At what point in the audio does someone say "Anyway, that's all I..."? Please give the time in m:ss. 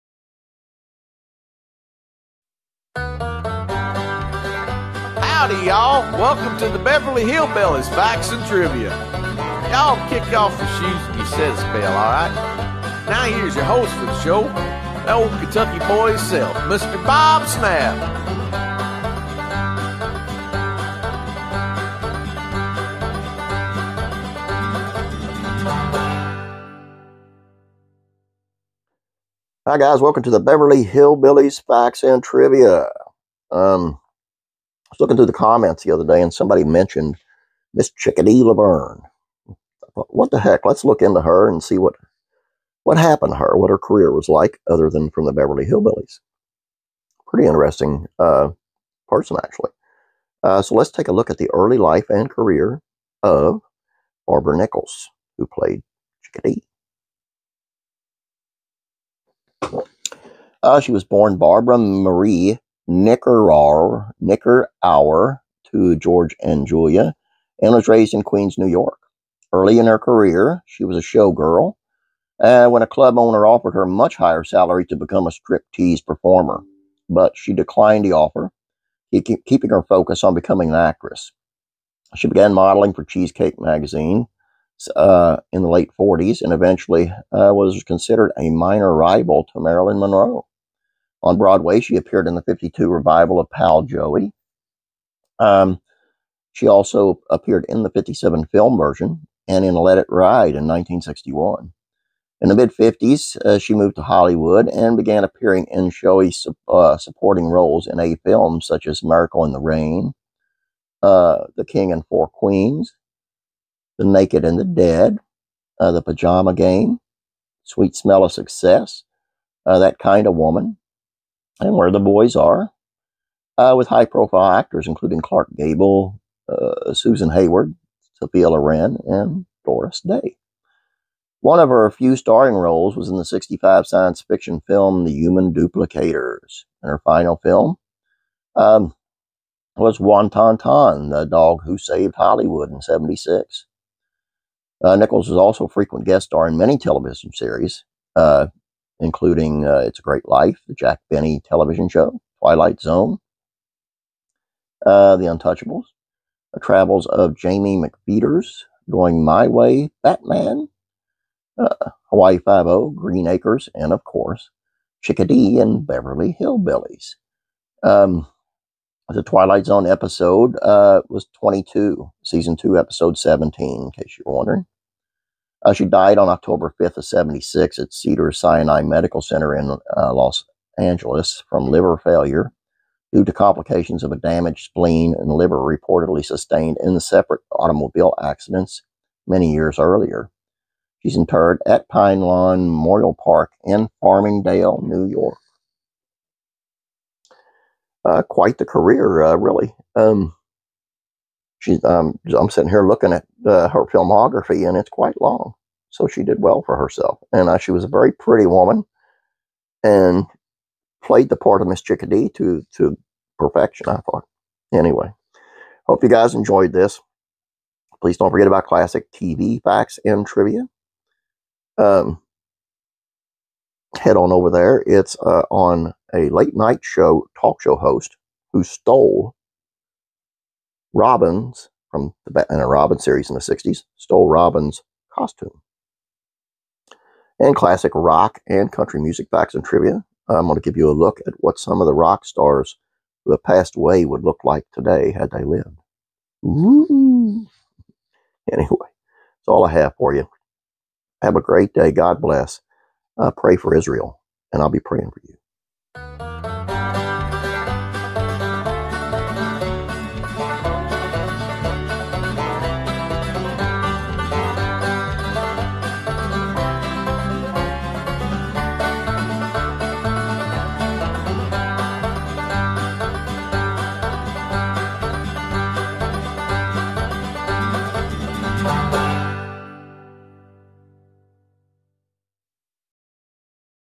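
4:08.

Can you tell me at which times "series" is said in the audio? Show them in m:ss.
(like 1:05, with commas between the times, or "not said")
2:27, 3:52.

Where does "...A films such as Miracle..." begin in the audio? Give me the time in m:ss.
1:47.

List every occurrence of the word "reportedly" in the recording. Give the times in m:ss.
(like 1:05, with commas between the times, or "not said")
3:05.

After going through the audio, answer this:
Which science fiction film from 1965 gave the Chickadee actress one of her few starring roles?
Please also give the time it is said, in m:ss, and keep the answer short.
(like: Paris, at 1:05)
The Human Duplicators, at 2:15.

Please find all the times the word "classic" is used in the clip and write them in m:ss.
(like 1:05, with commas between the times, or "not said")
3:38, 3:57.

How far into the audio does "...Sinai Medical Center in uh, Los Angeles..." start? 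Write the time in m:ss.
2:58.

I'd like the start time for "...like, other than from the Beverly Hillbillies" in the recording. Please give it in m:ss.
0:44.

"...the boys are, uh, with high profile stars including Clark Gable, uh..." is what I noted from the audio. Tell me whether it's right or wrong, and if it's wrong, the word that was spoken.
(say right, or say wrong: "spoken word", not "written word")
wrong: "actors", not "stars".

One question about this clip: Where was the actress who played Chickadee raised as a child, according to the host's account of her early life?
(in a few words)
Queens, New York.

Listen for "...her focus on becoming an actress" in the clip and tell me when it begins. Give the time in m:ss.
1:19.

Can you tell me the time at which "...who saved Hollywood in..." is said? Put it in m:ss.
2:21.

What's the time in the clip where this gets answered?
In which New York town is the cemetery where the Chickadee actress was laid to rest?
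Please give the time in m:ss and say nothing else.
3:14.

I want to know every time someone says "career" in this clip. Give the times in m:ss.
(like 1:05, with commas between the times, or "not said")
0:43, 0:52, 1:09, 3:18.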